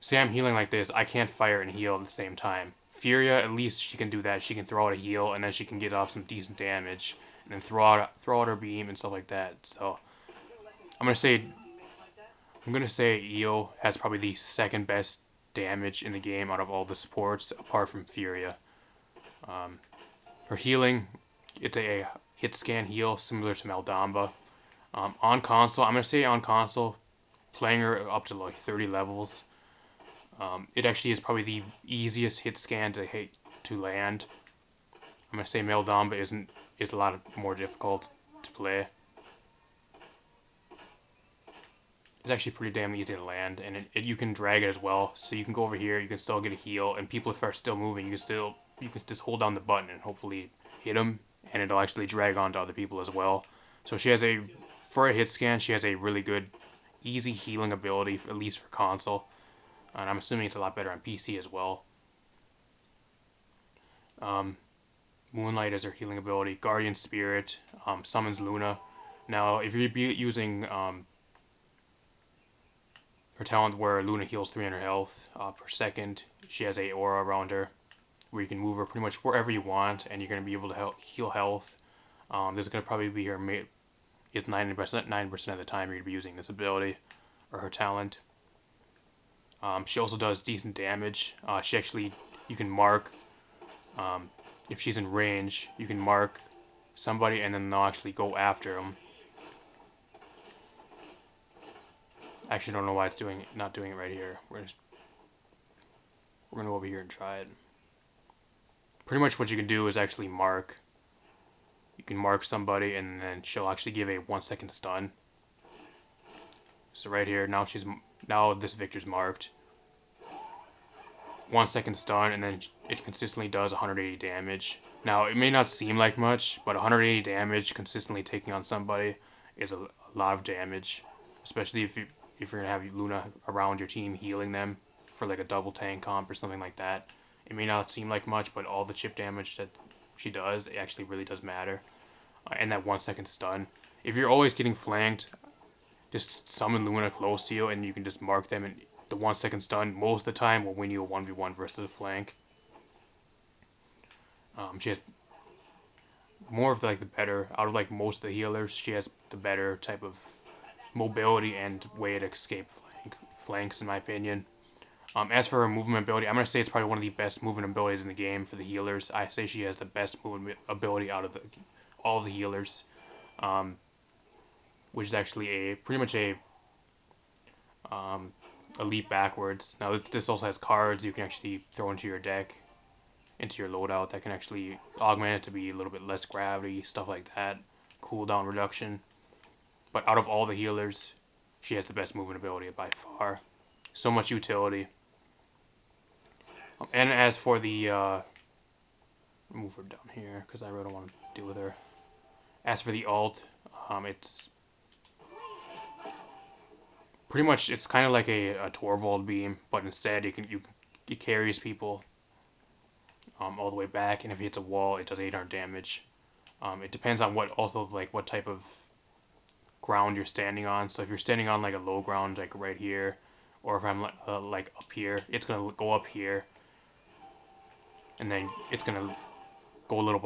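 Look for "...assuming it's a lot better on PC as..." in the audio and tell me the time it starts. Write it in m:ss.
1:00.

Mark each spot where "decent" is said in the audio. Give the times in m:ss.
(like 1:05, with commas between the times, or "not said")
0:06, 1:30.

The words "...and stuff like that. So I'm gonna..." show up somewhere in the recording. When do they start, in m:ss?
0:08.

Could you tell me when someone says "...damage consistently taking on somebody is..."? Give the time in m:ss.
2:07.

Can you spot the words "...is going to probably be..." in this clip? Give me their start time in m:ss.
1:22.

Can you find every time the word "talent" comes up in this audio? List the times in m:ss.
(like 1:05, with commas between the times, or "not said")
1:13, 1:27.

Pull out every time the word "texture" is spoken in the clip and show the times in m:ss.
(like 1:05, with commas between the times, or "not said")
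not said.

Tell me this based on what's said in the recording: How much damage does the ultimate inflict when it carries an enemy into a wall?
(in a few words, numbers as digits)
800.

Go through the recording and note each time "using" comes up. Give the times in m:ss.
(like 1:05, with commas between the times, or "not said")
1:10, 1:26.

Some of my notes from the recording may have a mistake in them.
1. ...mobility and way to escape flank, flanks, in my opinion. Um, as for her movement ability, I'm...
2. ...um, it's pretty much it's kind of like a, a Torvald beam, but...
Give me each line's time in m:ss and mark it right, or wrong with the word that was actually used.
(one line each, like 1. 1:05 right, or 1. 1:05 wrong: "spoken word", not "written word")
1. 2:40 right
2. 3:23 right.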